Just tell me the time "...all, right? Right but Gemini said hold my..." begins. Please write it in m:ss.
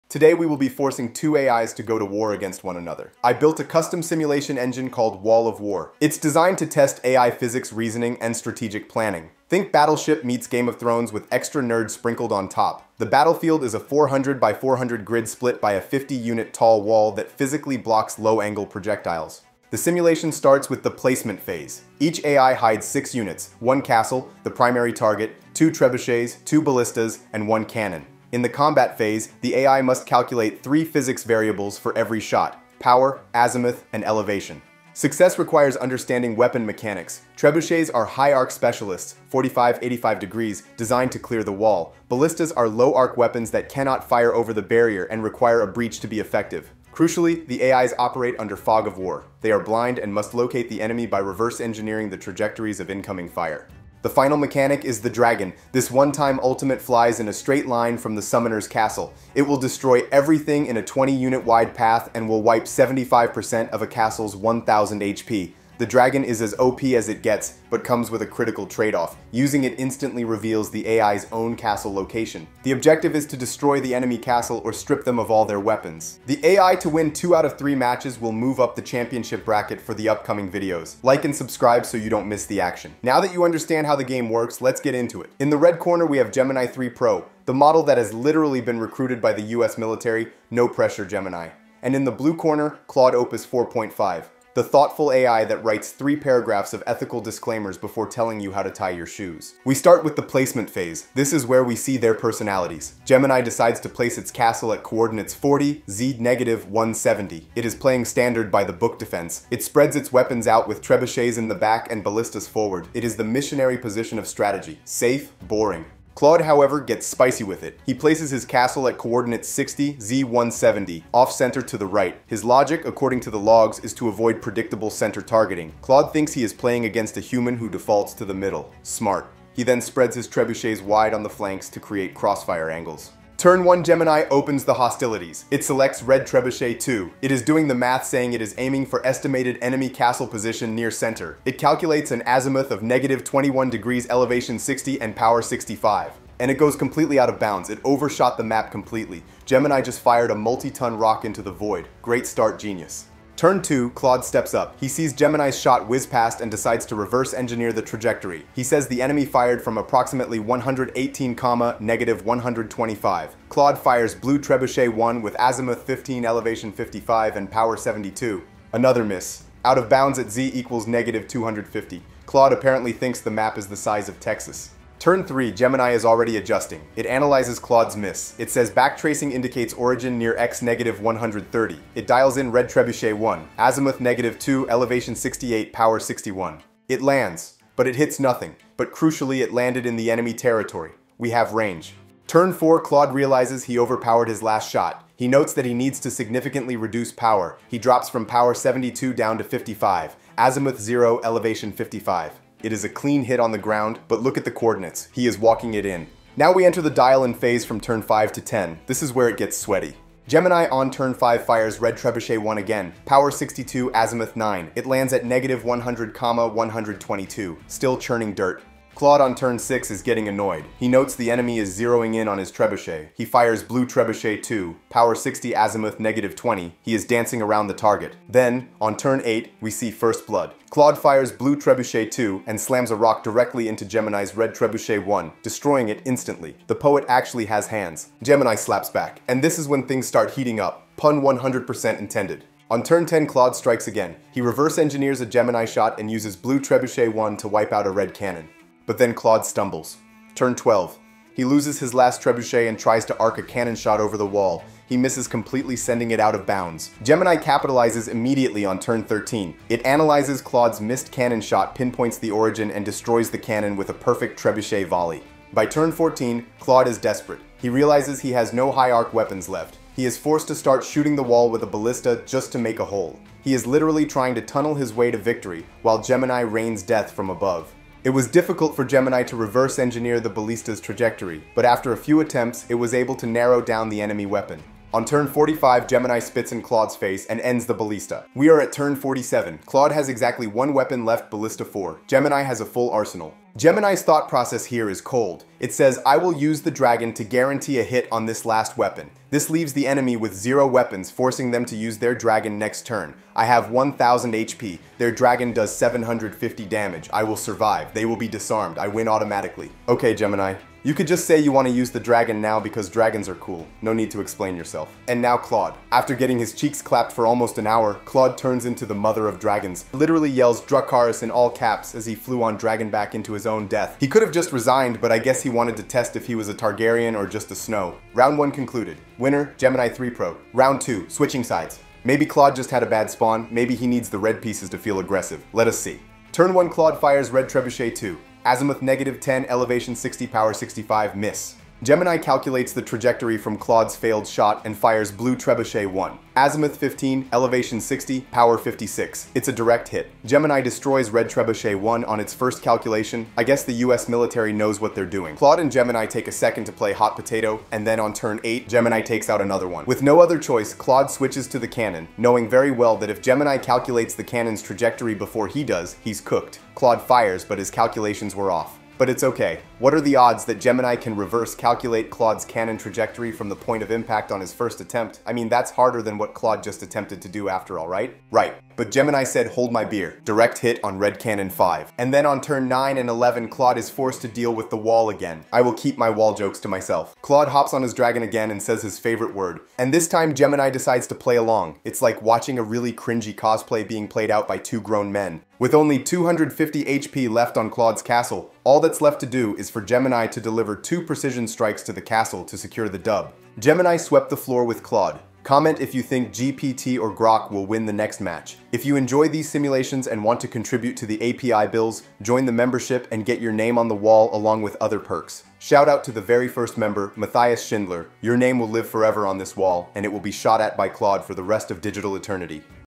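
6:17.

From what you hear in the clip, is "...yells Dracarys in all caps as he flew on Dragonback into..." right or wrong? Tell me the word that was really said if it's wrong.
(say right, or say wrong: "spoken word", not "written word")
right.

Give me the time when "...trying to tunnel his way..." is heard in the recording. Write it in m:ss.
4:34.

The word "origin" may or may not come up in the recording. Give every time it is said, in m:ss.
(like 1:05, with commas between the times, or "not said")
2:59, 4:22.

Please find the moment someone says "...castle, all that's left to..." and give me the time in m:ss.
6:38.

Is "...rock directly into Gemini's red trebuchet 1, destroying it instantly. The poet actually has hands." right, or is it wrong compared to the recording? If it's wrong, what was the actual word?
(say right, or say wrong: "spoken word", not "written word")
right.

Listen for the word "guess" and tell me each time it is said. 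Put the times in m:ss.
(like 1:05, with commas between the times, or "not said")
5:25, 5:53.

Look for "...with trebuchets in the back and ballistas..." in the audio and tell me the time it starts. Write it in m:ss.
1:50.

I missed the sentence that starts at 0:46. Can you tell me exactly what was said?
Crucially, the AIs operate under fog of war.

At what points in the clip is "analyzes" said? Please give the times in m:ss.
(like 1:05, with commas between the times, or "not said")
2:57, 4:19.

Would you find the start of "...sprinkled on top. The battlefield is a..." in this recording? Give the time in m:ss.
0:11.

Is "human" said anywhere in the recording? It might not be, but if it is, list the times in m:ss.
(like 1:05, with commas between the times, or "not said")
2:07.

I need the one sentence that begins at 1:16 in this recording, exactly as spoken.
The AI to win 2 out of 3 matches will move up the championship bracket for the upcoming videos.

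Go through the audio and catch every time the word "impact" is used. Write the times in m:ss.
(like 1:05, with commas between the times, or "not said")
6:13.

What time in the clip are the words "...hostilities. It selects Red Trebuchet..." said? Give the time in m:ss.
2:14.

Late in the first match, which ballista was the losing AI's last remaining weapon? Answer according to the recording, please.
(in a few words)
Ballista 4.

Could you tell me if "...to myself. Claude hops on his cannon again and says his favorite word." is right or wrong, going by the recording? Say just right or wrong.
wrong.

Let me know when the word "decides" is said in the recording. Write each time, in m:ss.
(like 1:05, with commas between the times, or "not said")
1:43, 2:36, 6:30.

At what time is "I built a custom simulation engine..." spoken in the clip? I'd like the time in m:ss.
0:03.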